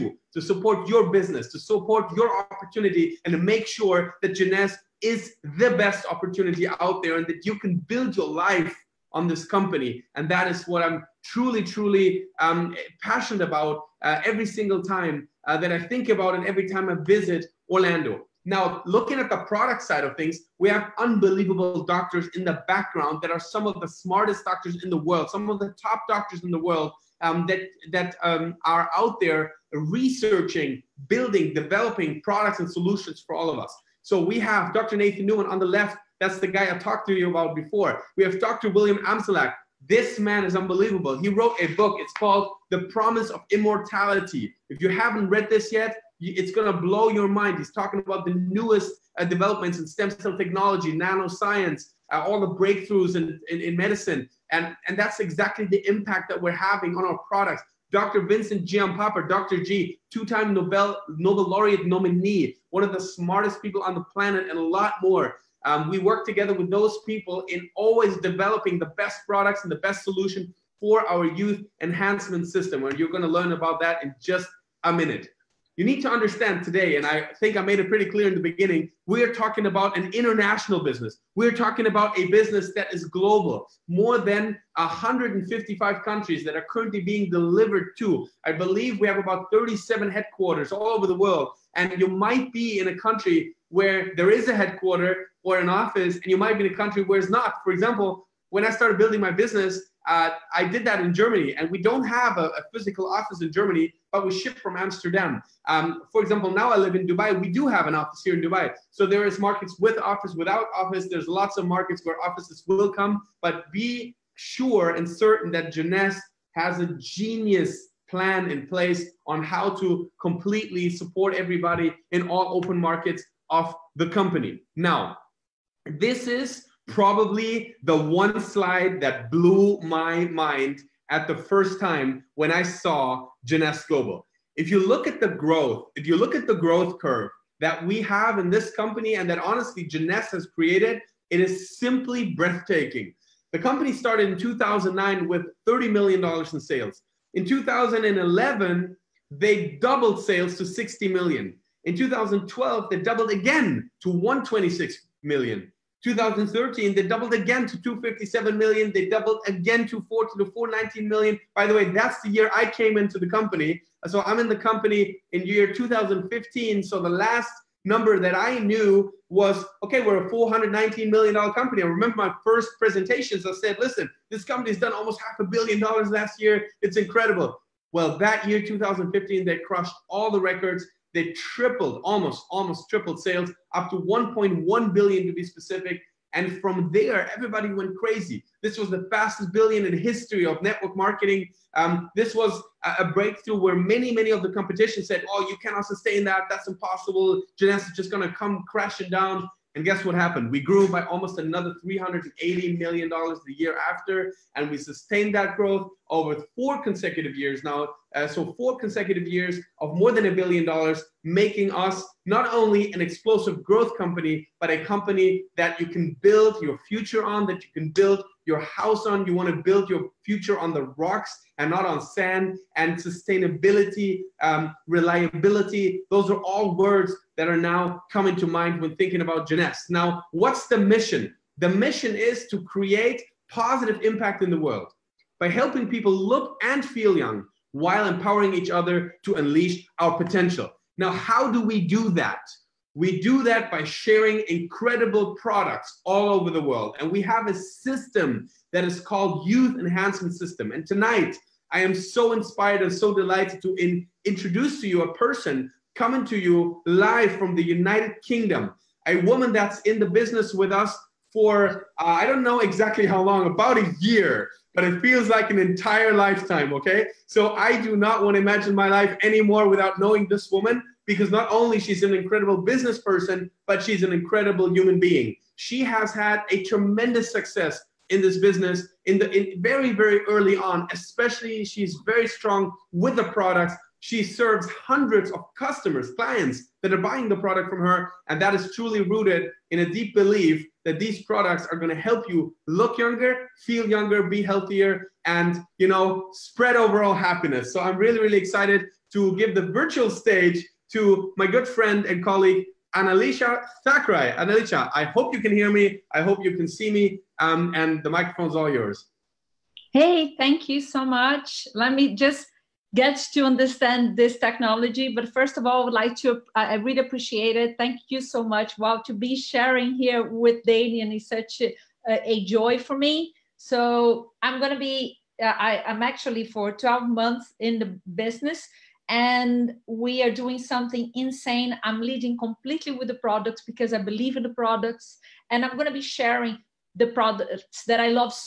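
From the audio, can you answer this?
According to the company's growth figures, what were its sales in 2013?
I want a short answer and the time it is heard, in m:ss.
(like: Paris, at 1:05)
257 million, at 2:37.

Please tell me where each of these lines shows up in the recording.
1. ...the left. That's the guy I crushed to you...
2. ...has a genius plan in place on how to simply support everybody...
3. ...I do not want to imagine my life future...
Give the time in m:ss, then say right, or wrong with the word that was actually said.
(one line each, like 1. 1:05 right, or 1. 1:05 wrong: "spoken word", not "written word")
1. 0:35 wrong: "talked", not "crushed"
2. 1:56 wrong: "completely", not "simply"
3. 4:27 wrong: "anymore", not "future".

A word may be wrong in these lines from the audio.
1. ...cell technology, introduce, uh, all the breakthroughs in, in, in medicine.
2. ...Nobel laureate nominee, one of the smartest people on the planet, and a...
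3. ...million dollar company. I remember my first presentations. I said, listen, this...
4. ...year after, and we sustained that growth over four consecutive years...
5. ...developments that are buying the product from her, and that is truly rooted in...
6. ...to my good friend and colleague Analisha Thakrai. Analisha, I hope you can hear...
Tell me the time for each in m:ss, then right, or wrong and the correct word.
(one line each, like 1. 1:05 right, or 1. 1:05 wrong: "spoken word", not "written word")
1. 0:50 wrong: "nanoscience", not "introduce"
2. 1:01 right
3. 2:51 right
4. 3:23 right
5. 4:46 wrong: "clients", not "developments"
6. 5:00 right.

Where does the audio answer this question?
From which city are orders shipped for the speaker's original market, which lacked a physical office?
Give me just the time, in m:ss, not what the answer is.
1:44.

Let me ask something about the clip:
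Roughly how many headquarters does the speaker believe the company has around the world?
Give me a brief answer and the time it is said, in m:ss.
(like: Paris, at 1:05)
37, at 1:29.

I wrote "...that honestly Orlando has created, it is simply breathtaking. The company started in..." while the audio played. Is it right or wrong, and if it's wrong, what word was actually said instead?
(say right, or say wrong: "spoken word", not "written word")
wrong: "Jeunesse", not "Orlando".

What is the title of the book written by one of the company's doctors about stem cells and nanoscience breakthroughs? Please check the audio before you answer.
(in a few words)
The Promise of Immortality.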